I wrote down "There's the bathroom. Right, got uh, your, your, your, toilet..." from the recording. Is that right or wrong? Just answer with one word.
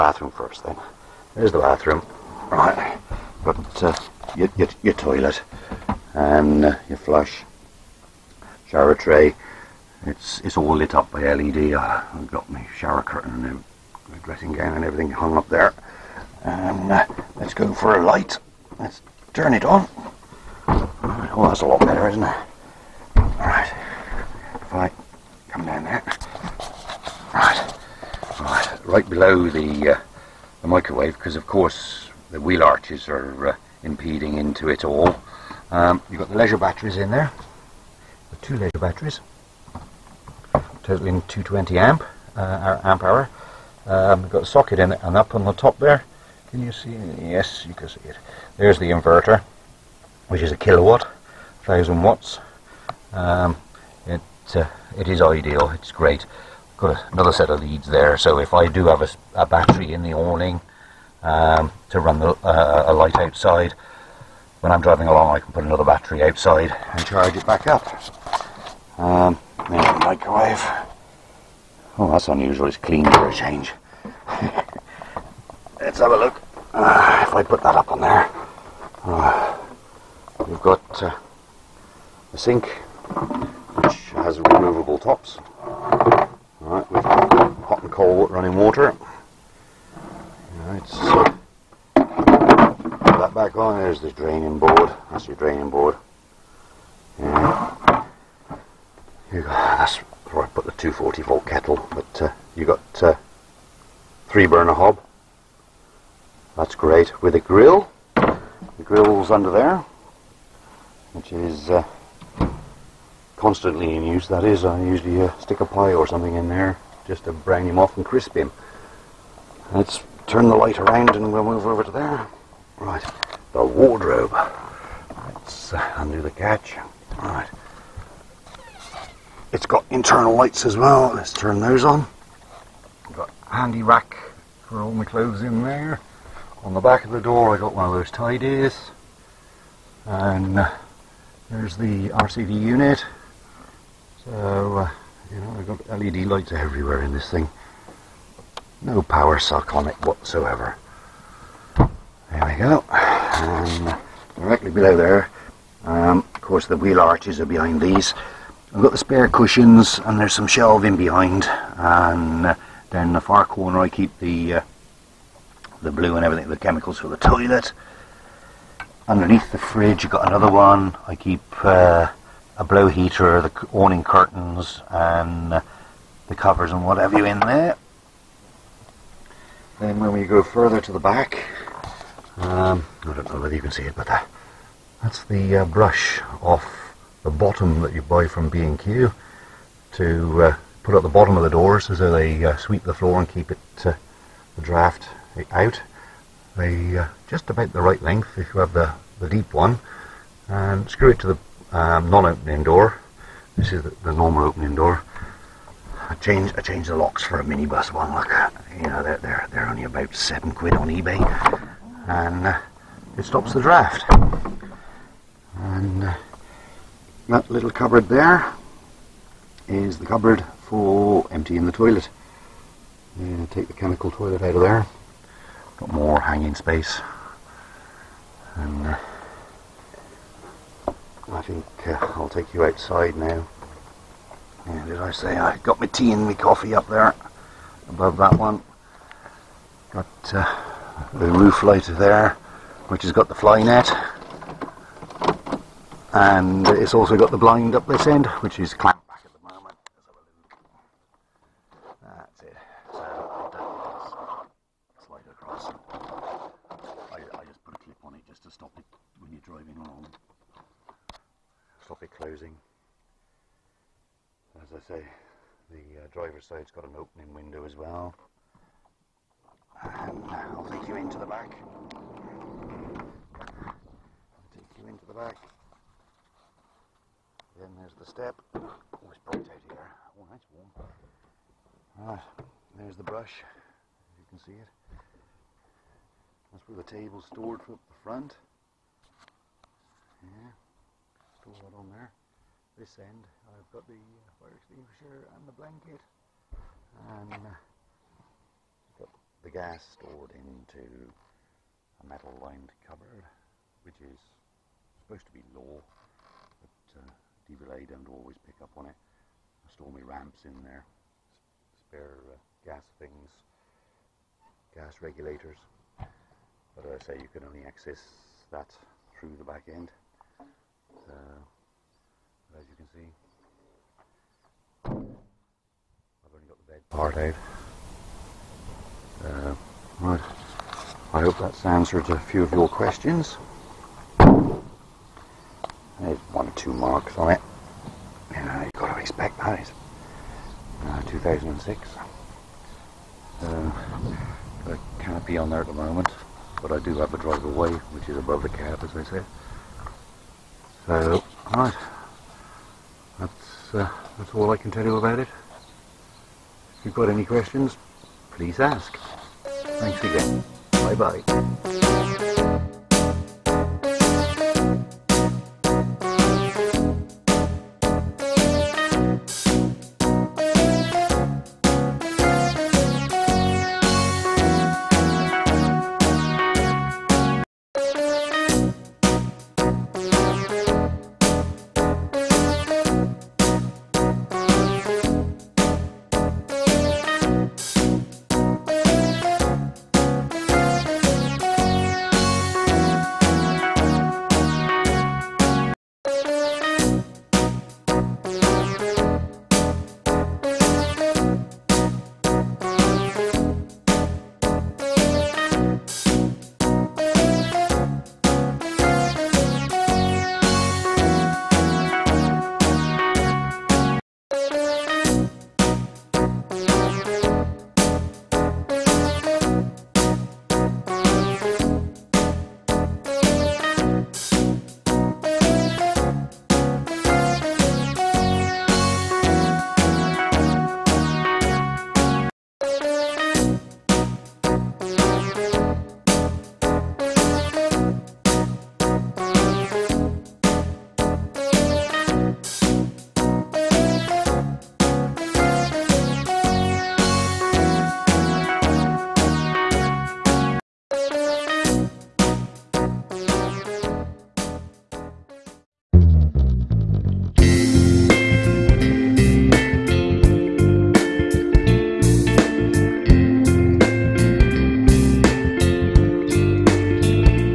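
right.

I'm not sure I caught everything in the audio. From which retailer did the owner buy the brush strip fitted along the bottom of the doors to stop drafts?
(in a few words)
B&Q.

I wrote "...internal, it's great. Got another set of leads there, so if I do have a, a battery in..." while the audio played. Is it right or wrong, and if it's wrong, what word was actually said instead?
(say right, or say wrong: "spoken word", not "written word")
wrong: "ideal", not "internal".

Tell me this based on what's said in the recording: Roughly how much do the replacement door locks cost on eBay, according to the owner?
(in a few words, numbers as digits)
about 7 pounds.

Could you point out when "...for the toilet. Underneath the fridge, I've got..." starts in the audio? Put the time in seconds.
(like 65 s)
166 s.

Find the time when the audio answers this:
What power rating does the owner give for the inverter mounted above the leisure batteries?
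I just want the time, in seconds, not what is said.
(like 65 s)
51 s.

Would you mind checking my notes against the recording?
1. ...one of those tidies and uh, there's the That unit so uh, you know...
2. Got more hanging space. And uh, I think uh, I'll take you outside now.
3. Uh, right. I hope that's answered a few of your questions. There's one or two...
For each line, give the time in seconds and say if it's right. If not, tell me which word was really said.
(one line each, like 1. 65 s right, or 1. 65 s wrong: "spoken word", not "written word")
1. 137 s wrong: "RCD", not "That"
2. 225 s right
3. 329 s right.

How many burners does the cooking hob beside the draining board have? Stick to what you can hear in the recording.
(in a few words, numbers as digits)
3.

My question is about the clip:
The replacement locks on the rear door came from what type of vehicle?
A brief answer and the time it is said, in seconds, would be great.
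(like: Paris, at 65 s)
minibus, at 207 s.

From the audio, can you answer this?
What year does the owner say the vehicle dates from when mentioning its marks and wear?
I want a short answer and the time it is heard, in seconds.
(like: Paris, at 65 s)
2006, at 341 s.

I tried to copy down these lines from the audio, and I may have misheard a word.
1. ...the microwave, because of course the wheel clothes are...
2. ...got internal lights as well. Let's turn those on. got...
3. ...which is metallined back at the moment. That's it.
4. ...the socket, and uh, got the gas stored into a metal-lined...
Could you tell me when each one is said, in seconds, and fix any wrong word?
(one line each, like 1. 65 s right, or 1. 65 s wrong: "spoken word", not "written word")
1. 30 s wrong: "arches", not "clothes"
2. 129 s right
3. 248 s wrong: "clamped", not "metallined"
4. 295 s wrong: "blanket", not "socket".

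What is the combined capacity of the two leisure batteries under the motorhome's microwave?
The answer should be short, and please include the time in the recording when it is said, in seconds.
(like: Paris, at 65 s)
220 amp hour, at 41 s.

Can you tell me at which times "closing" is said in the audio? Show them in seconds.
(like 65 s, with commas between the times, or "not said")
262 s.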